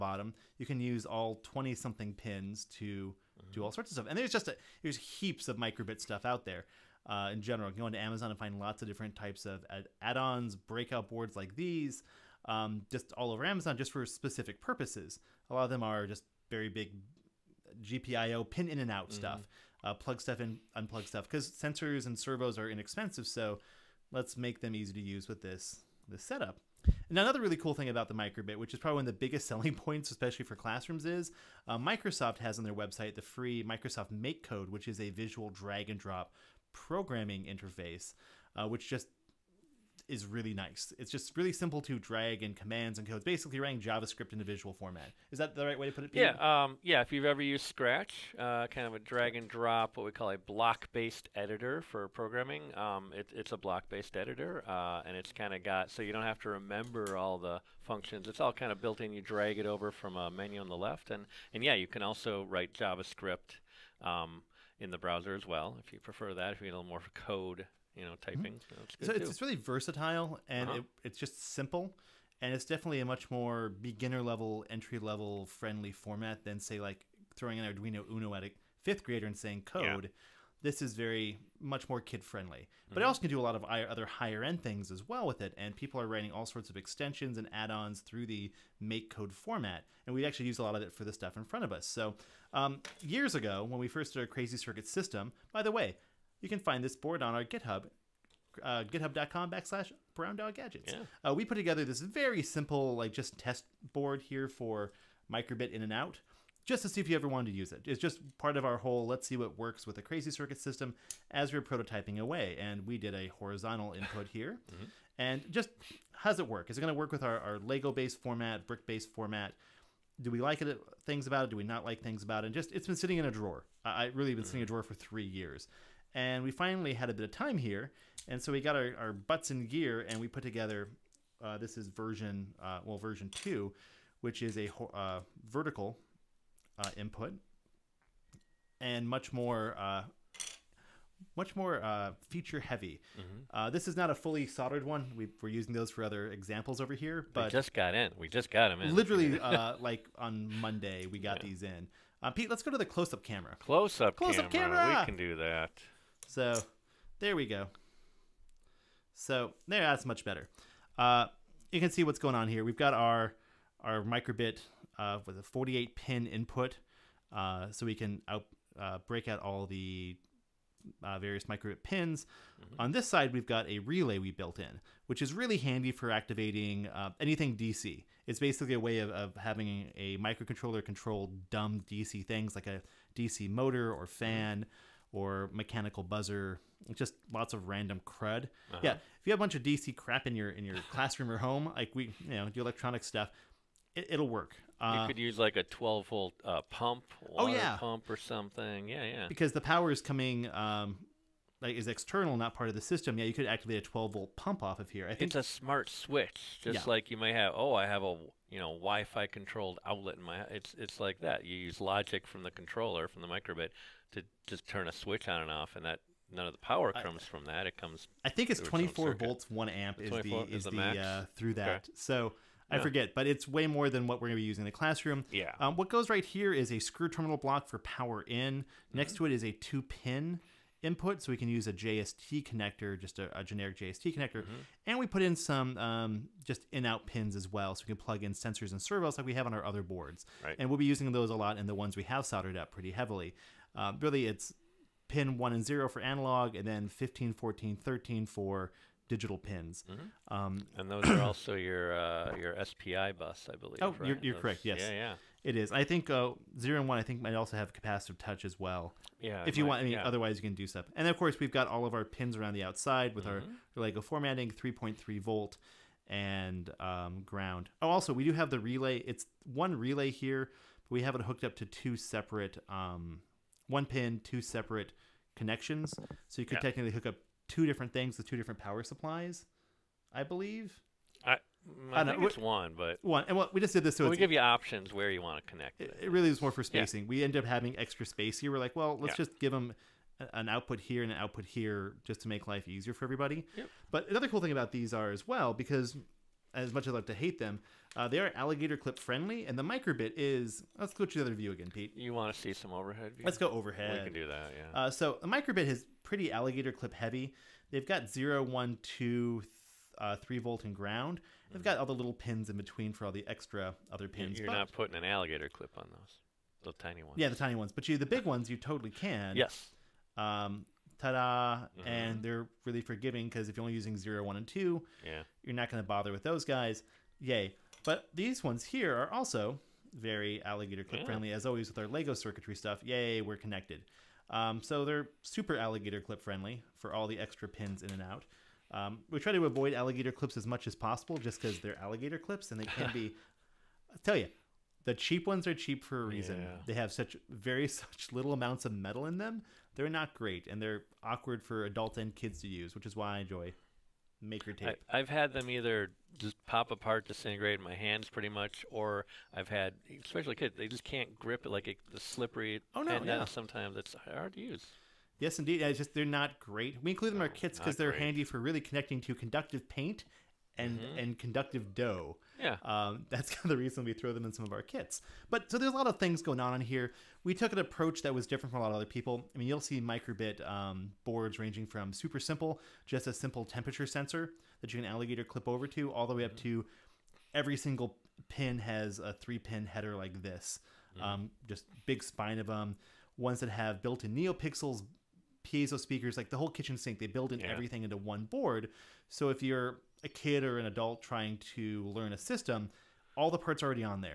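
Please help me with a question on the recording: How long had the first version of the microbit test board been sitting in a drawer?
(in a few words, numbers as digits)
3 years.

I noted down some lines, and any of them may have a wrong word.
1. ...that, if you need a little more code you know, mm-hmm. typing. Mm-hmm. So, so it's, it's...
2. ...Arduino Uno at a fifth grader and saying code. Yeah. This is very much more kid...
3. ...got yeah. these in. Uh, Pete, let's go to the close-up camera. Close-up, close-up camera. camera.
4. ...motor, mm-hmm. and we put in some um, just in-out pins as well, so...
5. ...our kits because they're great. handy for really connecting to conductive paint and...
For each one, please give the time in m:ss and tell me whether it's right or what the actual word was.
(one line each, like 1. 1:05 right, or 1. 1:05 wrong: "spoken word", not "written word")
1. 1:06 right
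2. 1:17 right
3. 2:31 right
4. 3:54 wrong: "connector", not "motor"
5. 6:07 right.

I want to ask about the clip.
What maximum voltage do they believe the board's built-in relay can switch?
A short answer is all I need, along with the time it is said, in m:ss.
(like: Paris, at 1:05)
24 volts, at 3:38.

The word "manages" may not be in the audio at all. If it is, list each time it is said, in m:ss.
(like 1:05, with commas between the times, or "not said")
not said.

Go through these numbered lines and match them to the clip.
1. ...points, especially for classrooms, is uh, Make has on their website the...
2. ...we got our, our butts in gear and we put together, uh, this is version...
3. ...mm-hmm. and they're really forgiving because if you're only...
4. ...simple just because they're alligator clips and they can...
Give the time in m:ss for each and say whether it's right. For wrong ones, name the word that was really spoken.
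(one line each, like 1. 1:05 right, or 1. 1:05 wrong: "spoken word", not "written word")
1. 0:29 wrong: "Microsoft", not "Make"
2. 2:08 right
3. 5:21 right
4. 5:40 wrong: "possible", not "simple".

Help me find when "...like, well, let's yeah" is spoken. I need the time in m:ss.
4:48.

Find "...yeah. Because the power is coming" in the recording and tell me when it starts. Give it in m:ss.
3:19.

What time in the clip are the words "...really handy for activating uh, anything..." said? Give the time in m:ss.
2:55.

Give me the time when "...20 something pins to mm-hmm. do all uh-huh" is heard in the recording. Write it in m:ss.
0:01.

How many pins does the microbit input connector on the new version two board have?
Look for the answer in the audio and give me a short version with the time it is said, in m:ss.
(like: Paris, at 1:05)
48, at 2:45.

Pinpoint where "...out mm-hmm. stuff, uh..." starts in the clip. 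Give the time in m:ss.
0:18.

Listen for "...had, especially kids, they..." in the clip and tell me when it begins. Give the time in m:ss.
5:59.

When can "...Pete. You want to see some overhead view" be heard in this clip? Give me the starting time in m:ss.
5:01.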